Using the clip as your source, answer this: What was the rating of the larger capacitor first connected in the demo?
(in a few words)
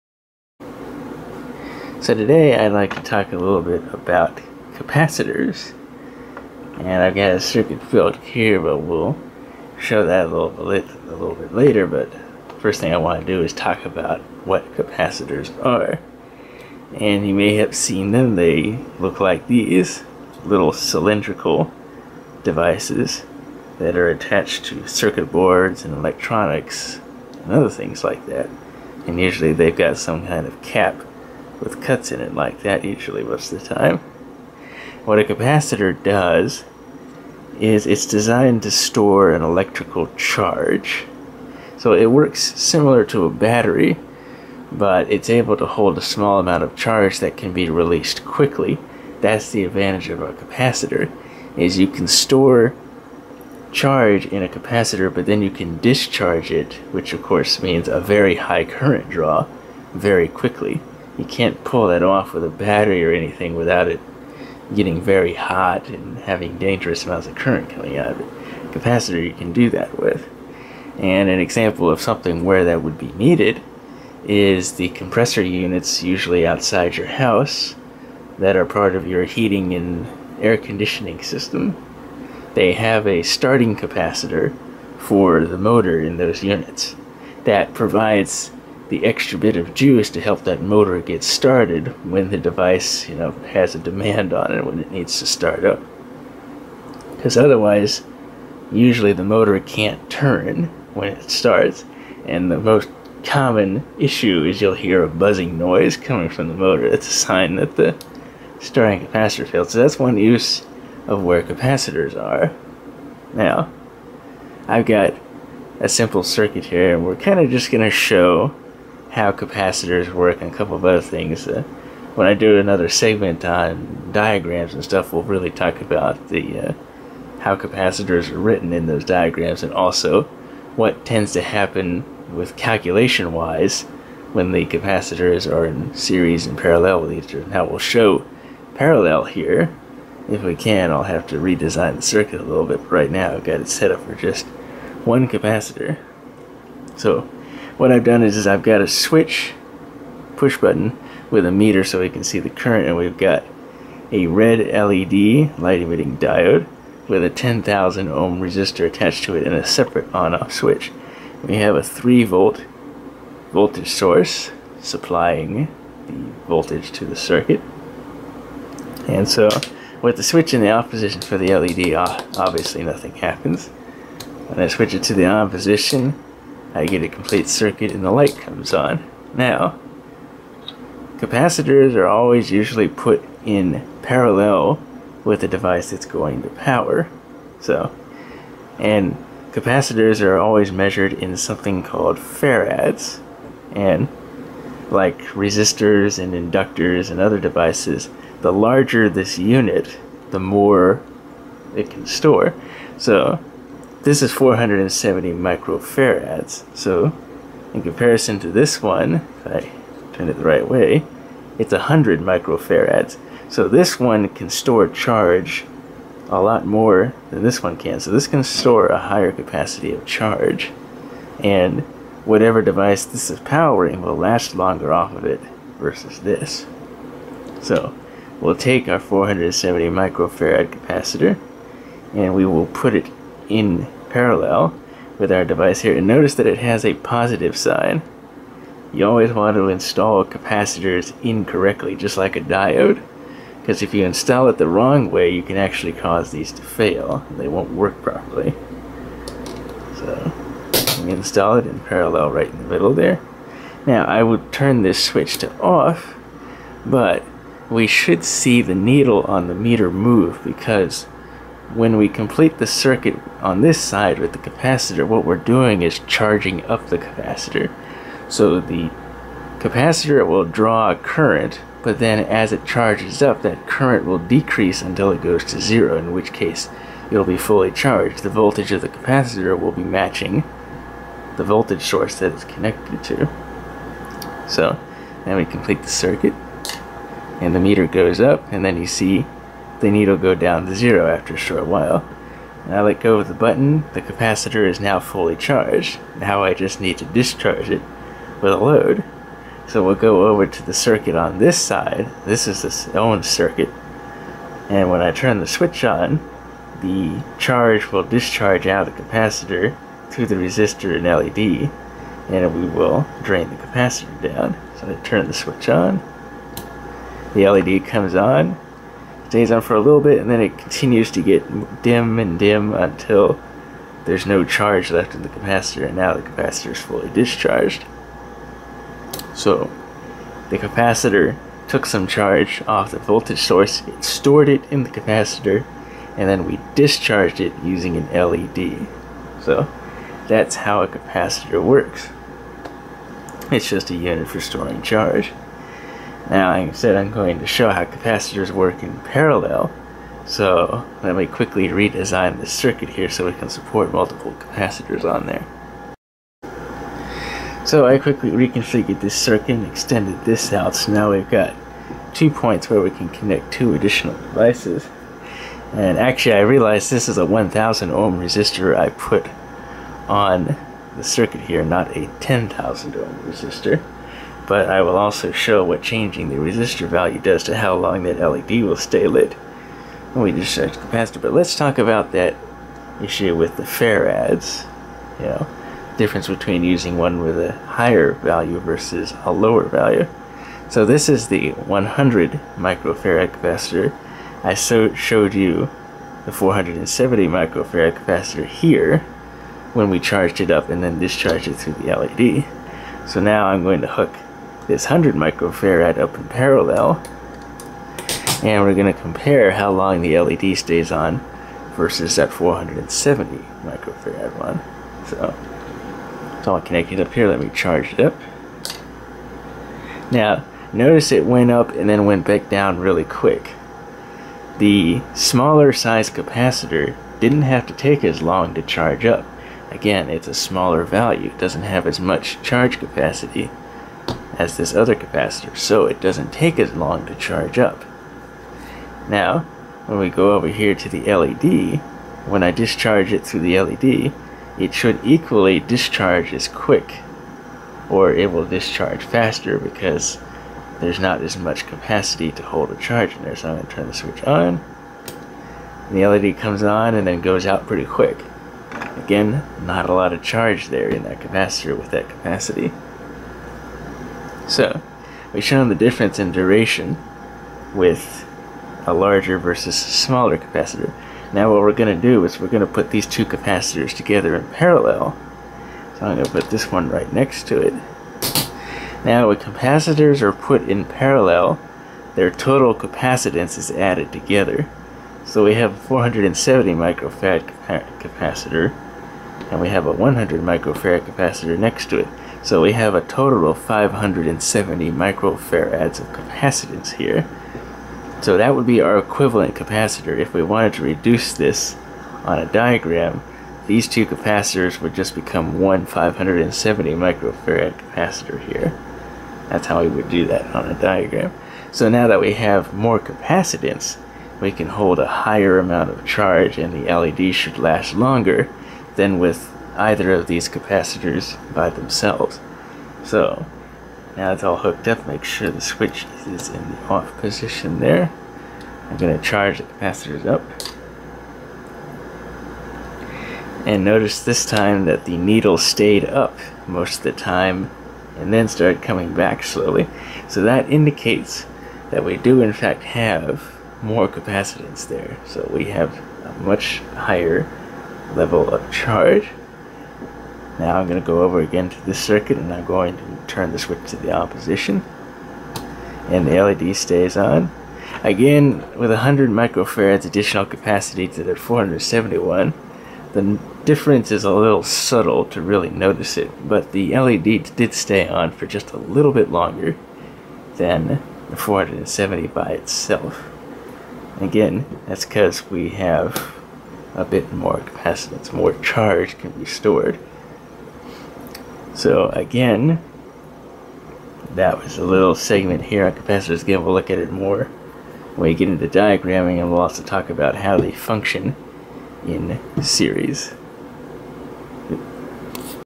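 470 microfarads.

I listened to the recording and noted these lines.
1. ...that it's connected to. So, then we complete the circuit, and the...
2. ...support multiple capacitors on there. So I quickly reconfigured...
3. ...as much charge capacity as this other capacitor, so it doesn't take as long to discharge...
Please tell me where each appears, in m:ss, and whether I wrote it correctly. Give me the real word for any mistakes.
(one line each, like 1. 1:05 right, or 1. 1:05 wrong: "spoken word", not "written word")
1. 4:42 right
2. 5:53 right
3. 7:11 wrong: "charge", not "discharge".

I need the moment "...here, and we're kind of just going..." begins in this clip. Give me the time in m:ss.
1:56.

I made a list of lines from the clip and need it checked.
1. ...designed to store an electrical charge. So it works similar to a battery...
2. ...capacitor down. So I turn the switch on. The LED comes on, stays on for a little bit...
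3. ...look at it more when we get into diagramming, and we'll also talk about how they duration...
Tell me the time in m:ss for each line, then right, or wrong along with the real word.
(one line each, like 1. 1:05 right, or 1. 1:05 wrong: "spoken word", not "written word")
1. 0:38 right
2. 5:13 right
3. 9:46 wrong: "function", not "duration".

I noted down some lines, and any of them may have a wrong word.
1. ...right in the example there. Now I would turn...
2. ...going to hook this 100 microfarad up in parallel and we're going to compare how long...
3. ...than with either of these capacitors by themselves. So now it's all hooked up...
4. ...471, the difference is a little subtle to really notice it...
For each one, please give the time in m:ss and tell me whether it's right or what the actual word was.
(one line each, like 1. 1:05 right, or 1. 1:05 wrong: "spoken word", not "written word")
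1. 4:12 wrong: "middle", not "example"
2. 6:43 right
3. 8:38 right
4. 9:21 right.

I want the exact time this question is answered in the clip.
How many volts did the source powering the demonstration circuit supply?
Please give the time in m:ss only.
2:41.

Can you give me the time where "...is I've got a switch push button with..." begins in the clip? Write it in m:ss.
2:28.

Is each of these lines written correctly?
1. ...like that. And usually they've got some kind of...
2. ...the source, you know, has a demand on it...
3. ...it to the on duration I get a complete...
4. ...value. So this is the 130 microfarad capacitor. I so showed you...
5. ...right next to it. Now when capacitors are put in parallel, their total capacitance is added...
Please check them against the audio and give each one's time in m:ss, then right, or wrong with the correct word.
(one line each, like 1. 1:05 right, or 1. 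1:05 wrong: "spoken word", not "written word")
1. 0:28 right
2. 1:32 wrong: "device", not "source"
3. 2:54 wrong: "position", not "duration"
4. 6:29 wrong: "100", not "130"
5. 7:56 right.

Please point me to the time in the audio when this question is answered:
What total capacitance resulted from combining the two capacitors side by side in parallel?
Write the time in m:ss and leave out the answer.
8:13.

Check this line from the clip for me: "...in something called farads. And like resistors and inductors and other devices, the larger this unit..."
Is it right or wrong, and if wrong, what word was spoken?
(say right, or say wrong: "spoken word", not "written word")
right.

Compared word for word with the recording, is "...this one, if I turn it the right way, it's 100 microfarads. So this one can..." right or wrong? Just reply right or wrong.
right.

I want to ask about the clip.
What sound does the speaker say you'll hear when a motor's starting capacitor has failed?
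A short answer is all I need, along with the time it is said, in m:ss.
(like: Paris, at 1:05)
Buzzing noise, at 1:45.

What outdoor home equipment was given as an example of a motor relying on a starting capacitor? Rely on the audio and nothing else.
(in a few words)
Compressor units.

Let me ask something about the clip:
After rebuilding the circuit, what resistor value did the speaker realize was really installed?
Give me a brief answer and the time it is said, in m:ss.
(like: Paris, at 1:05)
1000 ohm, at 6:07.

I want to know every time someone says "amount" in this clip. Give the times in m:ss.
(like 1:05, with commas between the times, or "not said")
0:46, 1:07, 8:35.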